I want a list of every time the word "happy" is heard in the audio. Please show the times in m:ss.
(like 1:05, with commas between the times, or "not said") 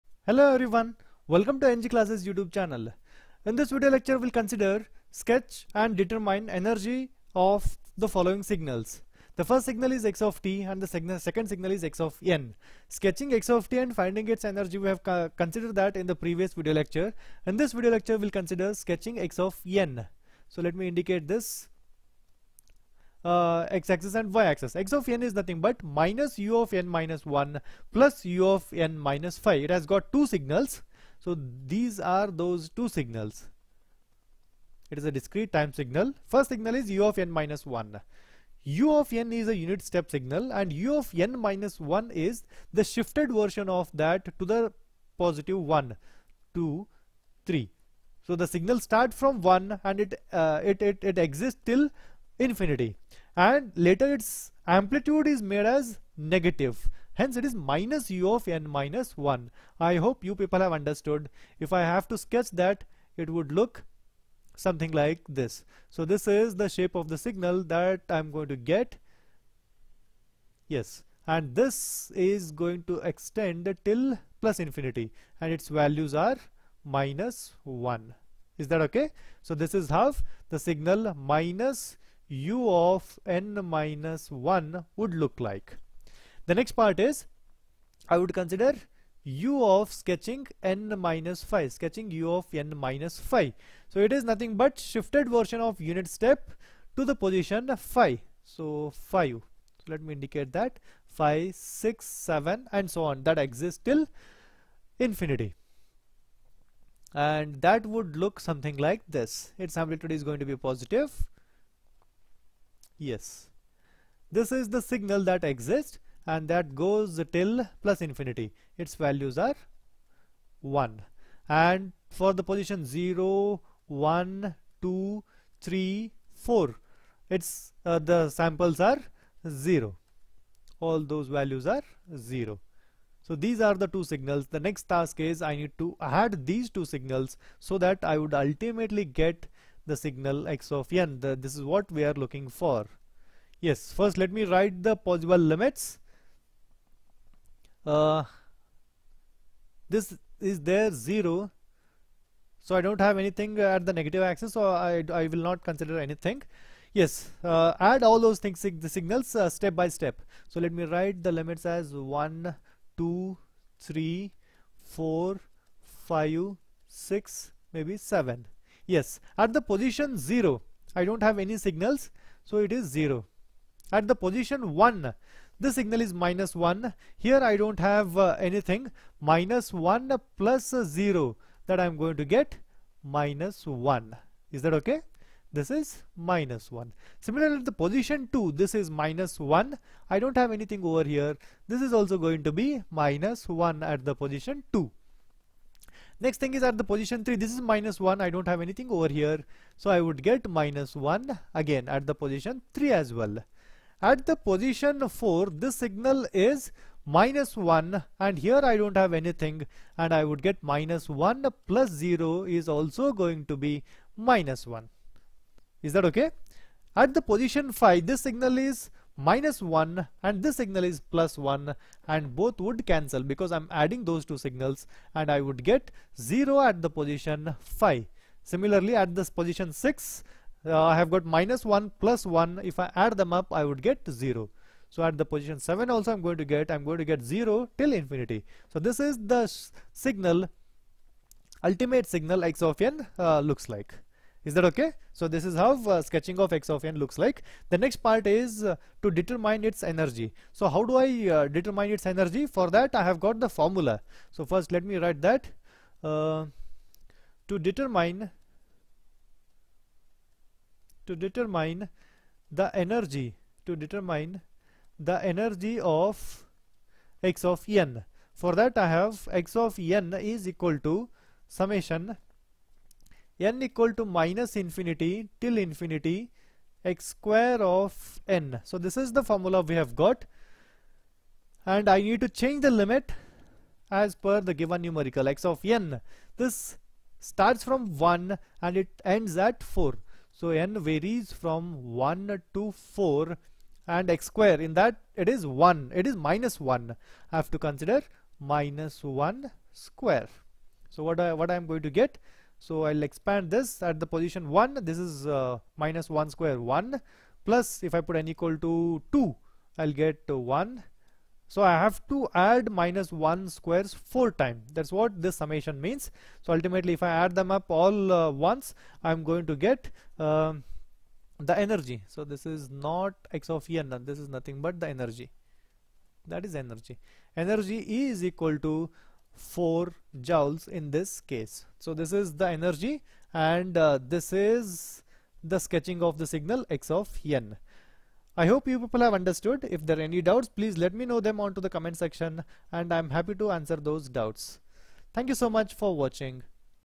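5:43.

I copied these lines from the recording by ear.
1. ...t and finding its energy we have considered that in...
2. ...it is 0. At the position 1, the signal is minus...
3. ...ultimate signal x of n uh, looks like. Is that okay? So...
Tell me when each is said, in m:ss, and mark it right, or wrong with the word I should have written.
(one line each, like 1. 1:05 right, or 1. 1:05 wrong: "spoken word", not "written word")
1. 0:13 right
2. 2:52 right
3. 4:01 right.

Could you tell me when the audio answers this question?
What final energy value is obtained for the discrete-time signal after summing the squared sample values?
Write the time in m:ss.
5:29.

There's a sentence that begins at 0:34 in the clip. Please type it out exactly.
It is a discrete time signal.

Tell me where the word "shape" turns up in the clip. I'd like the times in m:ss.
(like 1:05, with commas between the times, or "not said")
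1:06.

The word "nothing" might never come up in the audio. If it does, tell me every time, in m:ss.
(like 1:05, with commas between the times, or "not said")
0:25, 1:34, 5:24.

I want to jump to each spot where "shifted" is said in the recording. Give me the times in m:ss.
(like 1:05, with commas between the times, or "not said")
0:42, 1:34.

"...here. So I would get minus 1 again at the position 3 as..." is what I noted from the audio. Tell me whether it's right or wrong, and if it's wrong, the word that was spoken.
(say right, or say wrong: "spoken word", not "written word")
right.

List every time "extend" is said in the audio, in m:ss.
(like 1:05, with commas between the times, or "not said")
1:13.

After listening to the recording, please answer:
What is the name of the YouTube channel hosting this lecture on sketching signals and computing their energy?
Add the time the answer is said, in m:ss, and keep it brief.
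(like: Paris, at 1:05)
EnggClasses, at 0:01.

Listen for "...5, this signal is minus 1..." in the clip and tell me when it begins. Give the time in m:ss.
3:37.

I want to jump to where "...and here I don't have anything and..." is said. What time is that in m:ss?
3:28.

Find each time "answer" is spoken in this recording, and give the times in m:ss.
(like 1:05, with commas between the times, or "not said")
5:43.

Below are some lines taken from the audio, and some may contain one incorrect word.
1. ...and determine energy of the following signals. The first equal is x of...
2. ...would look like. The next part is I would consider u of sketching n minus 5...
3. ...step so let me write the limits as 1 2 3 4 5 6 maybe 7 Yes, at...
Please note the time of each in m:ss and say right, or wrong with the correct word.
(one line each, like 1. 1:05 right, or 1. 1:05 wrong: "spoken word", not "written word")
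1. 0:05 wrong: "signal", not "equal"
2. 1:24 right
3. 2:39 right.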